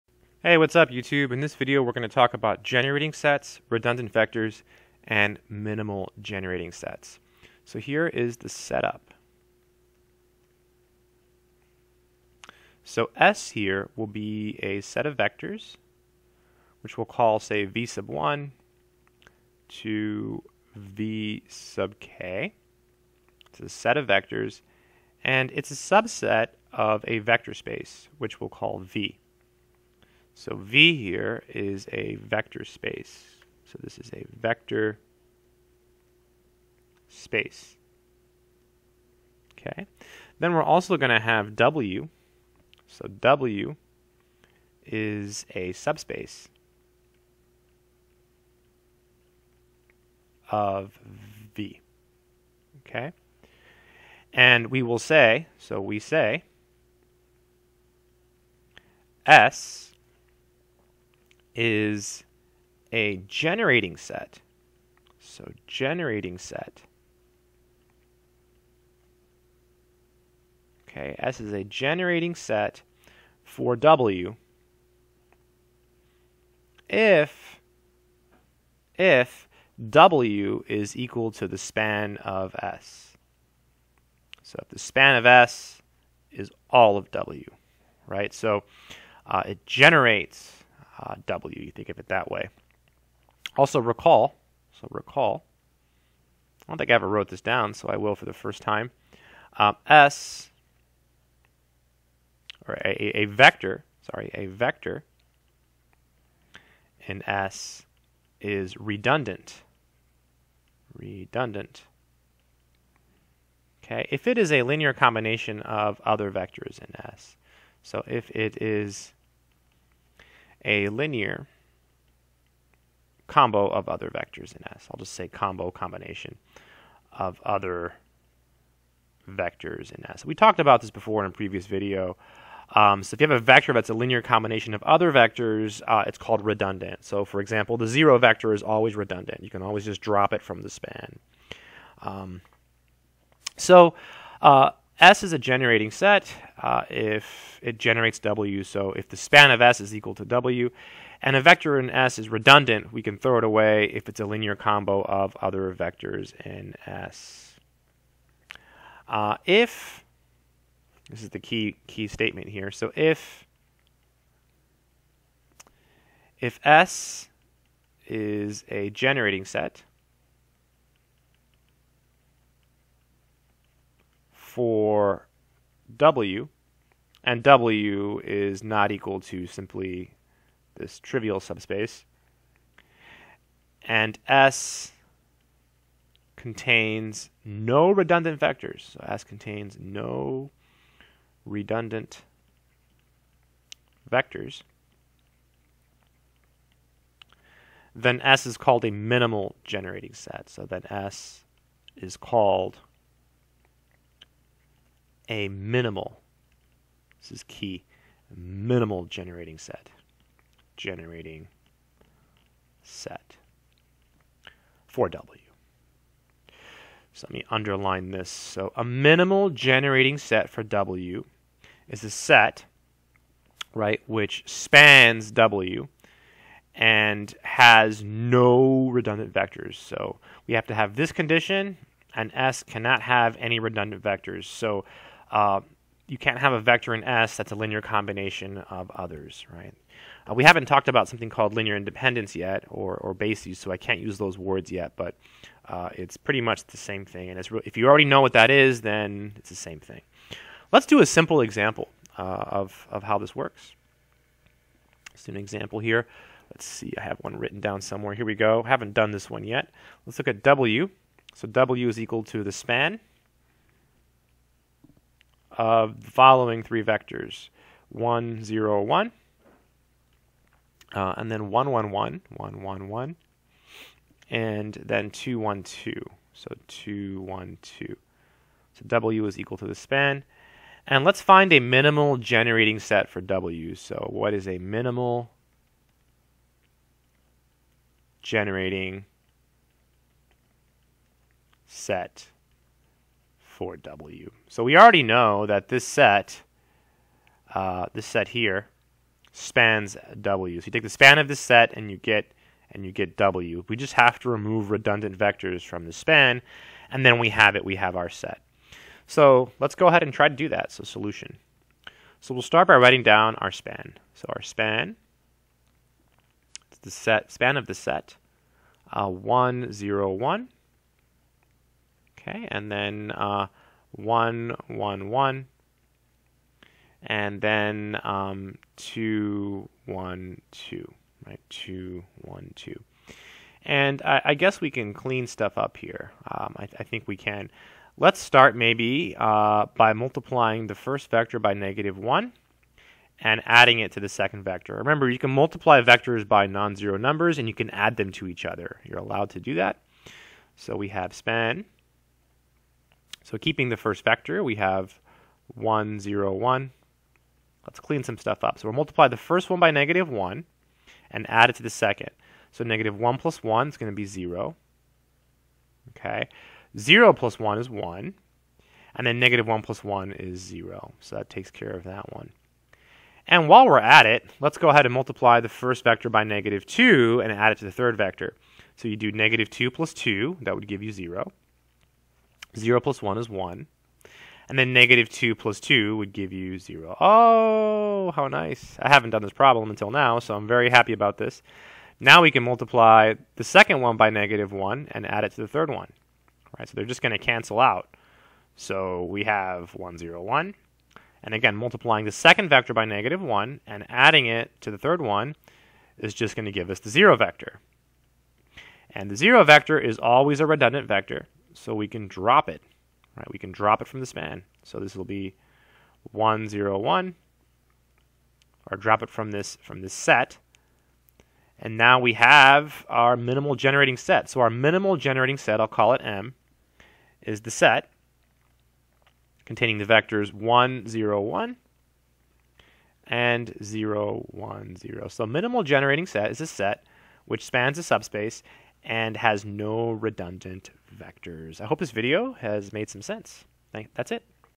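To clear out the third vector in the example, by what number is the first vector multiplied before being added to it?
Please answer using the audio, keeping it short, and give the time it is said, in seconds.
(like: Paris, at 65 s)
-2, at 374 s.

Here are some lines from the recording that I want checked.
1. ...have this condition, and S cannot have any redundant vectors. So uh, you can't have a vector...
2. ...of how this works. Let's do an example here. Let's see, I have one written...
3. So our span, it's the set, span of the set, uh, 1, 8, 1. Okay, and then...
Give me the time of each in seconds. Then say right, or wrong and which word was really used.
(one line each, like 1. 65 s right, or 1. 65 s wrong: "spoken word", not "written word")
1. 230 s right
2. 252 s right
3. 314 s wrong: "0", not "8".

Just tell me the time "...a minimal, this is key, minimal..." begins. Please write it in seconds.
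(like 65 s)
205 s.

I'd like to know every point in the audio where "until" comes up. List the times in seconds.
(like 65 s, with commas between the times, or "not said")
389 s.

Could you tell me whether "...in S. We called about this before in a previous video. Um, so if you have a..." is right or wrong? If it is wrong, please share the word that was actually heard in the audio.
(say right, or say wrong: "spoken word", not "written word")
wrong: "talked", not "called".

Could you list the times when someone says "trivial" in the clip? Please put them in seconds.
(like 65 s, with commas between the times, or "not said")
180 s.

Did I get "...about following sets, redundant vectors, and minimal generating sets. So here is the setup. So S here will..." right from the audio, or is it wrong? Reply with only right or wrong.
wrong.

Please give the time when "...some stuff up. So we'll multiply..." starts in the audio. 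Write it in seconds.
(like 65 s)
358 s.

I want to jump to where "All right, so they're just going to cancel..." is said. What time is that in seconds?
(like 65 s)
396 s.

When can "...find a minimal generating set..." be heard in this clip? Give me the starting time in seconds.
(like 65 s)
281 s.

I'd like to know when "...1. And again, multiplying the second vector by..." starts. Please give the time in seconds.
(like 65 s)
400 s.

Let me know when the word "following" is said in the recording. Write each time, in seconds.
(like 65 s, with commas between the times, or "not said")
266 s.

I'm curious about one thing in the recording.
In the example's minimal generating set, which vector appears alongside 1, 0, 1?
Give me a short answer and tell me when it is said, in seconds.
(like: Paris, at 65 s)
0, 1, 0, at 433 s.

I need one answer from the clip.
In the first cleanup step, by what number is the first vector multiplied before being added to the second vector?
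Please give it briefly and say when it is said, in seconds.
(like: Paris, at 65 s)
-1, at 339 s.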